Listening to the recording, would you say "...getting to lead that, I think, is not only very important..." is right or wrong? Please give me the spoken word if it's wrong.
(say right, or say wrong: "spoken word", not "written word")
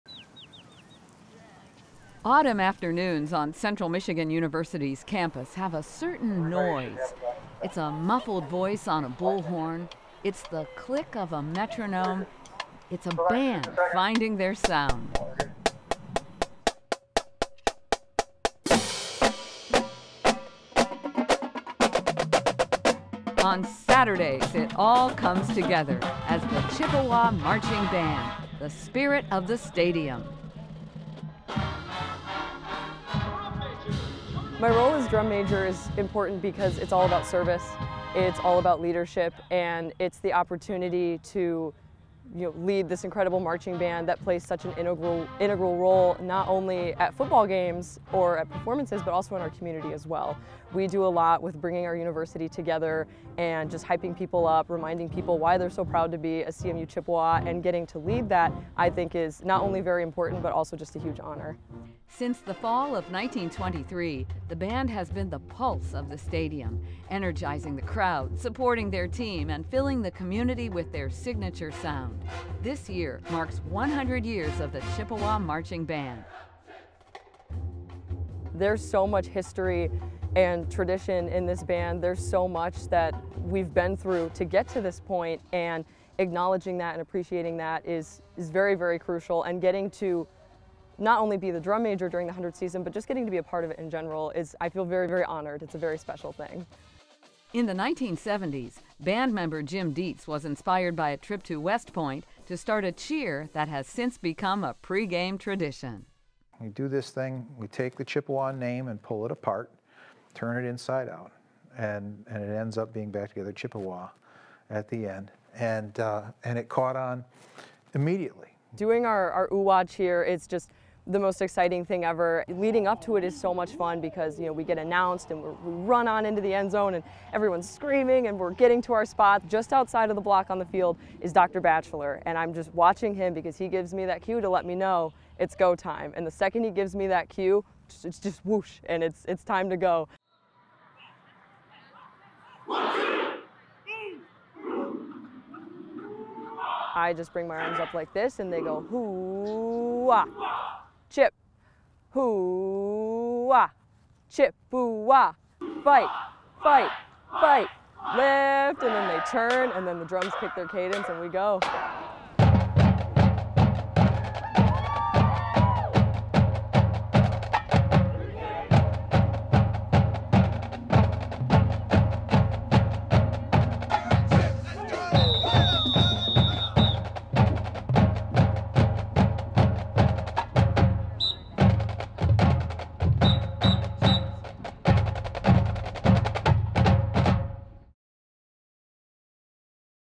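right.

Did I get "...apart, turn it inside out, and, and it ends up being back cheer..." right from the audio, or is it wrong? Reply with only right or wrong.
wrong.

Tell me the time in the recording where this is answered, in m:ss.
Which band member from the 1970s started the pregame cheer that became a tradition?
1:39.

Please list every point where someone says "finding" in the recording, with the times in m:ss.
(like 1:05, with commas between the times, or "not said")
0:13.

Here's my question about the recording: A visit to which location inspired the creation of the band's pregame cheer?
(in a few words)
West Point.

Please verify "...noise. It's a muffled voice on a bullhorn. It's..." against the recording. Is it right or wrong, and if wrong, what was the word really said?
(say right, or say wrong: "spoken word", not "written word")
right.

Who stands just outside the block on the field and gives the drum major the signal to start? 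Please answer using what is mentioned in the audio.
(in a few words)
Dr. Batchelor.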